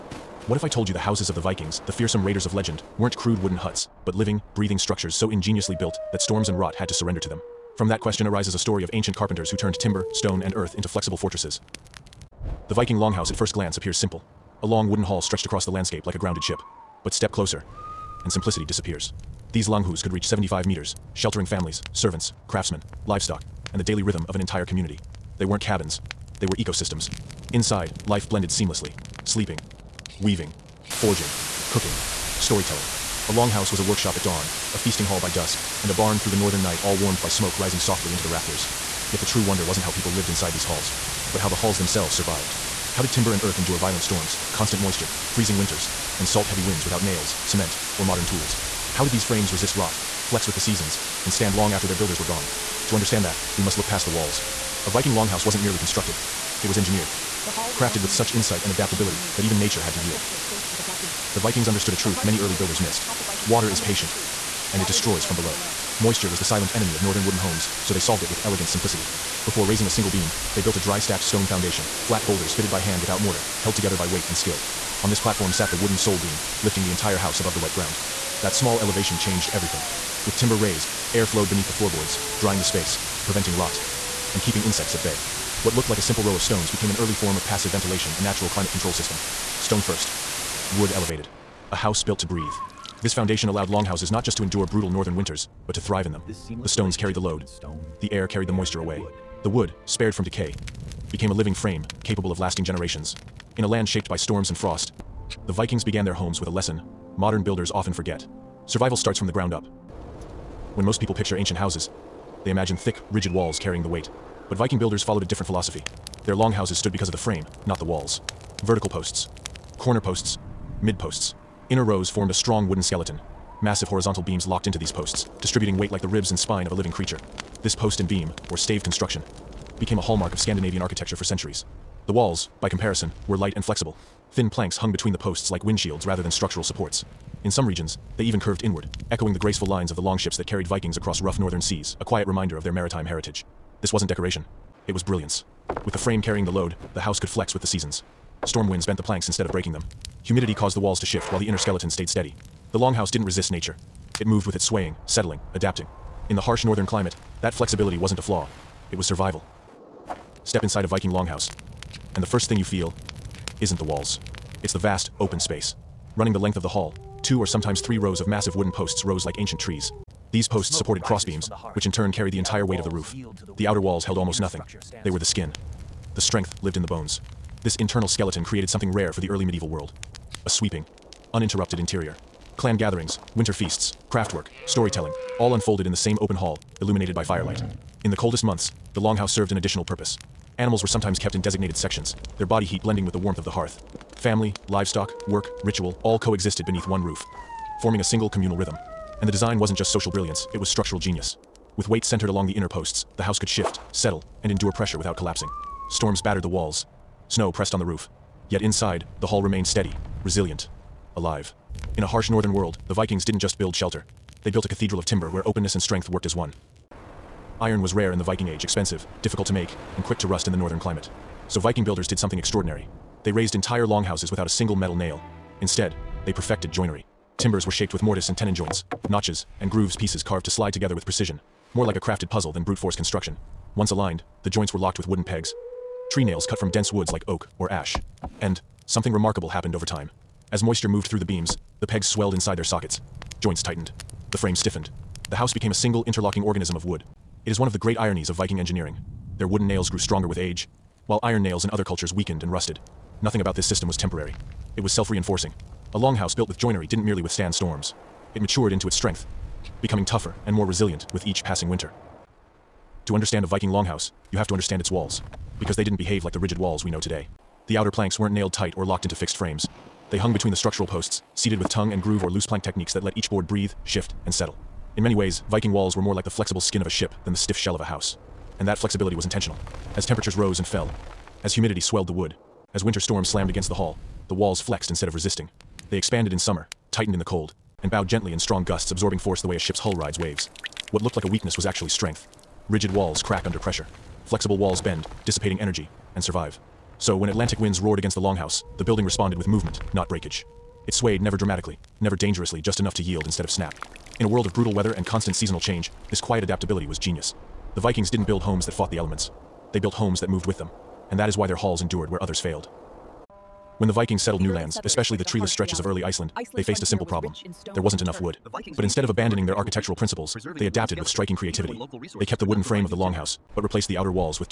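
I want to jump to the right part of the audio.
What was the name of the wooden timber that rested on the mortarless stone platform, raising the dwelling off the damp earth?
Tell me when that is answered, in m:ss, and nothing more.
1:15.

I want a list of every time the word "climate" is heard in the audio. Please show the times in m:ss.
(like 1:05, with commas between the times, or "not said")
1:28, 2:36, 3:40.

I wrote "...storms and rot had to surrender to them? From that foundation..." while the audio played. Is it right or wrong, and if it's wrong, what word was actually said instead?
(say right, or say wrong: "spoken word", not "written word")
wrong: "question", not "foundation".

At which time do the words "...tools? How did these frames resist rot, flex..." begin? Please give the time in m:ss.
0:48.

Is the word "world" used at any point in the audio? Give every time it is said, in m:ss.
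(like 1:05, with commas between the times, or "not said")
2:59, 3:32, 5:04.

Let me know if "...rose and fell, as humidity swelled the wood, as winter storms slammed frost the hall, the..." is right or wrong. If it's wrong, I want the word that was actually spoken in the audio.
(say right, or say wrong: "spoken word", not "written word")
wrong: "against", not "frost".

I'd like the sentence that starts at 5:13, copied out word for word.
When the Vikings settled new lands, especially the treeless stretches of early Iceland, they faced a simple problem.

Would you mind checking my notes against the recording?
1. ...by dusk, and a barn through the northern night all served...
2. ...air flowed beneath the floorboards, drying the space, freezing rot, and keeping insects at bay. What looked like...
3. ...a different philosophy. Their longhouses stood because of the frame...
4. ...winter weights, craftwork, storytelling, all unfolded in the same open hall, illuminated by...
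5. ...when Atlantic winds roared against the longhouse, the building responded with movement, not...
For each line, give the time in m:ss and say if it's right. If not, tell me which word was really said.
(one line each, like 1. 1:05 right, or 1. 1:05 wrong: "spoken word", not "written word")
1. 0:35 wrong: "warmed", not "served"
2. 1:21 wrong: "preventing", not "freezing"
3. 1:55 right
4. 3:03 wrong: "feasts", not "weights"
5. 4:57 right.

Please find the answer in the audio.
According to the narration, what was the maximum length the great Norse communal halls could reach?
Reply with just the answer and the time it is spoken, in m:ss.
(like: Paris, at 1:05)
75 meters, at 0:20.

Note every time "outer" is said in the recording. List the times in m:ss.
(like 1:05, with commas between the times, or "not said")
2:53, 4:27, 5:23.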